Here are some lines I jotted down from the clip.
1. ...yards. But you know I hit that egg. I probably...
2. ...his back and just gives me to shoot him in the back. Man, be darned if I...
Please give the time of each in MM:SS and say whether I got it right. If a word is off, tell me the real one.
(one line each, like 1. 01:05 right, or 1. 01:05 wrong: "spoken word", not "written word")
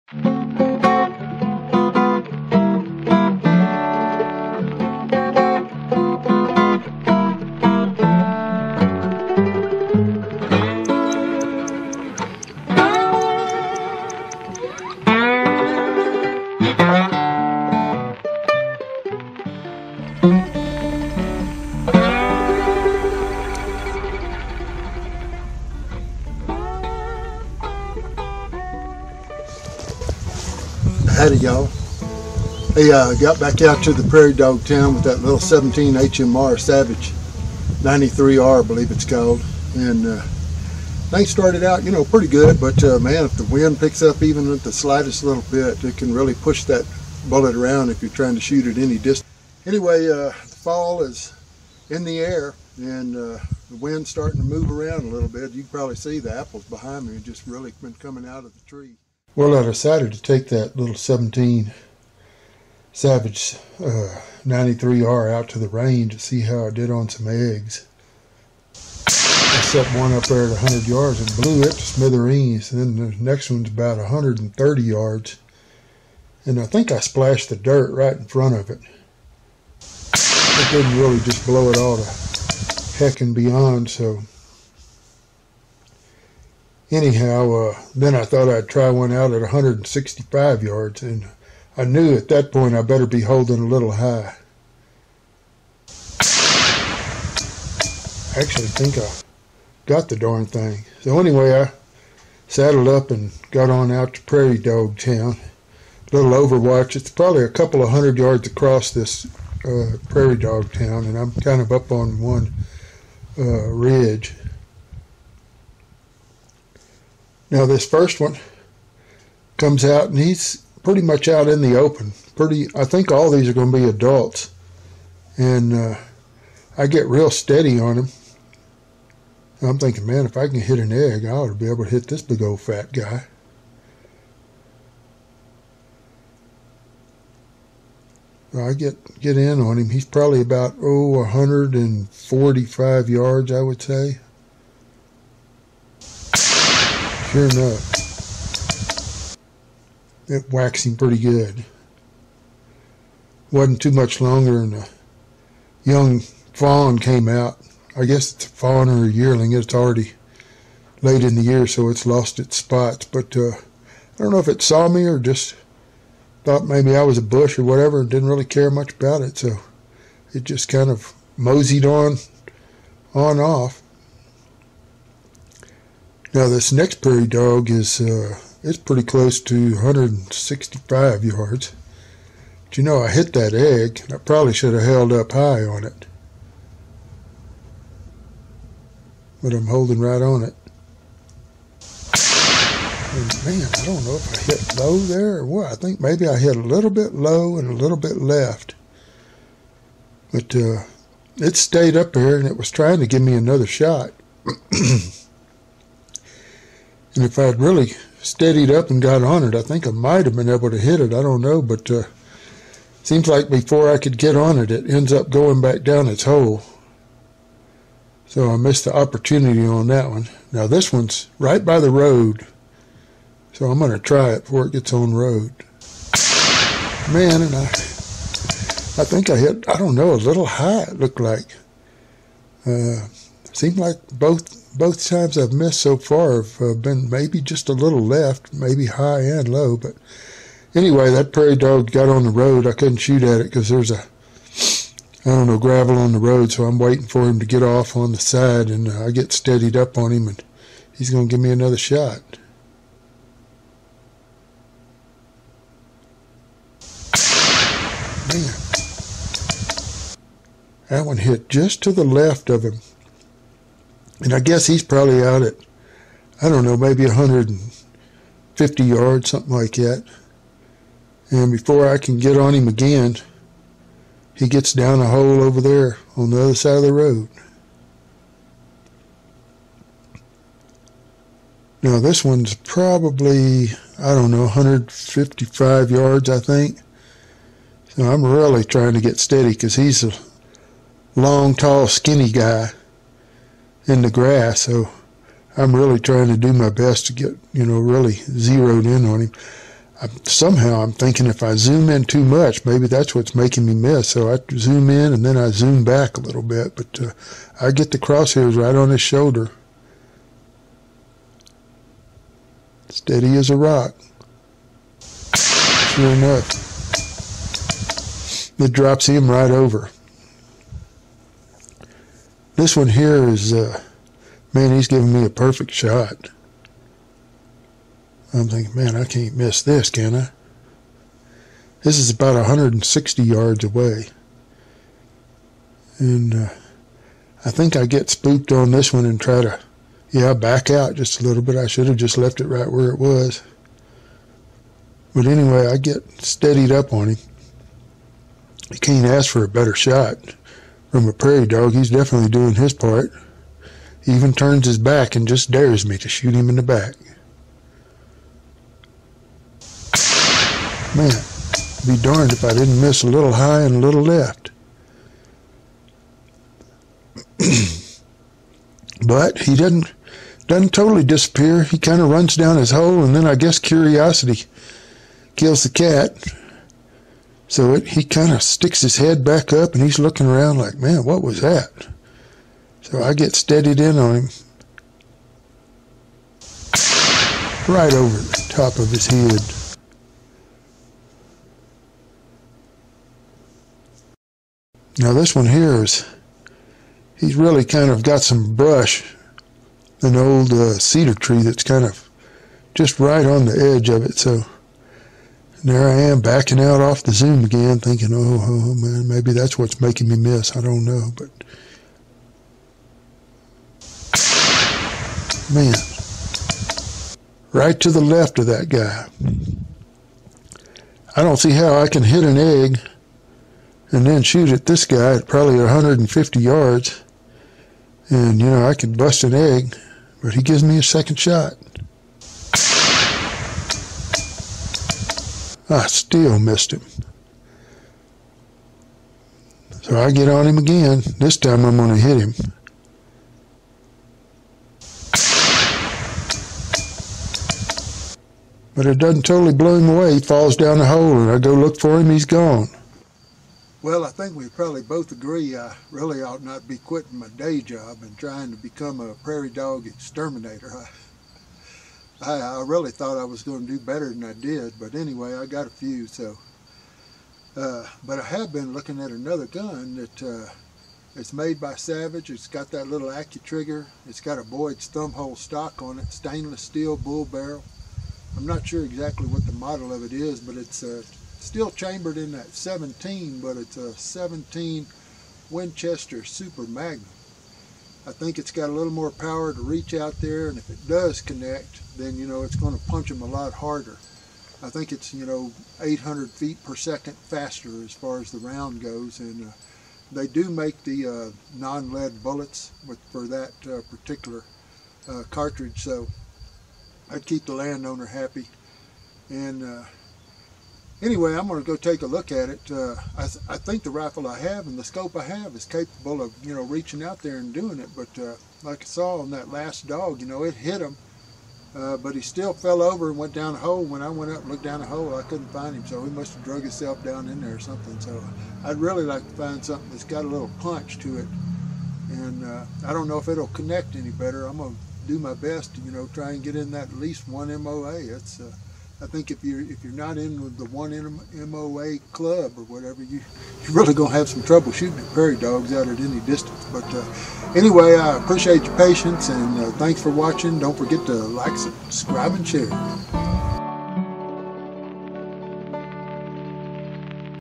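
1. 03:01 right
2. 05:54 wrong: "dares", not "gives".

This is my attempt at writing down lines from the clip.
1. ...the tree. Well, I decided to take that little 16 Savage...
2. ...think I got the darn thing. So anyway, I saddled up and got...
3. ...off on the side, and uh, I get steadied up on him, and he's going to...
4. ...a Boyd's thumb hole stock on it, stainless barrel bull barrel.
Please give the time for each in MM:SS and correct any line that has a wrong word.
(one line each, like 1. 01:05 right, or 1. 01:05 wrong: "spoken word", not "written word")
1. 00:58 wrong: "17", not "16"
2. 01:38 right
3. 04:07 right
4. 07:54 wrong: "steel", not "barrel".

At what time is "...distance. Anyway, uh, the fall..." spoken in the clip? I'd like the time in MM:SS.
00:48.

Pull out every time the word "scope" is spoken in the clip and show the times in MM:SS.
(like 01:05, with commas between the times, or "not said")
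08:34.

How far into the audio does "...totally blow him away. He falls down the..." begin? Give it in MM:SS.
07:29.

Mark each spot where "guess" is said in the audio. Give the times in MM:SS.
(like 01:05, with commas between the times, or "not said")
02:38, 04:24, 06:13.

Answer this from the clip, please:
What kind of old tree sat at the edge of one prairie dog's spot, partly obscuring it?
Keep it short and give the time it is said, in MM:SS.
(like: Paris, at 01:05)
cedar, at 06:40.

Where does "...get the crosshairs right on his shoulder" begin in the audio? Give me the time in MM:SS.
05:07.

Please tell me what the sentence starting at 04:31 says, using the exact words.
And before I can get on him again, he gets down a hole over there on the other side of the road.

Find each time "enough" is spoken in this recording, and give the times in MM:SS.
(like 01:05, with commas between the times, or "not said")
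02:27, 05:16.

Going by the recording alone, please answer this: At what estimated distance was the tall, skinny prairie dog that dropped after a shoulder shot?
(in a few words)
155 yards.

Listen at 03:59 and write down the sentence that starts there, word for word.
But anyway, that prairie dog got on the road.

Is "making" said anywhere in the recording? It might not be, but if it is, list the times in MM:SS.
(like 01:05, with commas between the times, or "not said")
05:03, 06:49.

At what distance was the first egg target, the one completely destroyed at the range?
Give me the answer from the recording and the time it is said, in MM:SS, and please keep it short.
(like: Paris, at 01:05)
100 yards, at 01:10.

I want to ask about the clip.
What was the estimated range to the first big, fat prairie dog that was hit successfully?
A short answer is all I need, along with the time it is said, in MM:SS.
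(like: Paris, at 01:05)
145 yards, at 02:21.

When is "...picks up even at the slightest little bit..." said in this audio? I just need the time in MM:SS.
00:43.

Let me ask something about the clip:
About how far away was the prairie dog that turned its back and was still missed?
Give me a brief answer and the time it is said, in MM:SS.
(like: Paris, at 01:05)
160 yards, at 05:32.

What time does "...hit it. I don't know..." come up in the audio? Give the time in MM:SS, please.
03:30.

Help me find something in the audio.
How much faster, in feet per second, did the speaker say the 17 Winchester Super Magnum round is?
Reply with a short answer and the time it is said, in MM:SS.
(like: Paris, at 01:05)
800 feet per second, at 08:15.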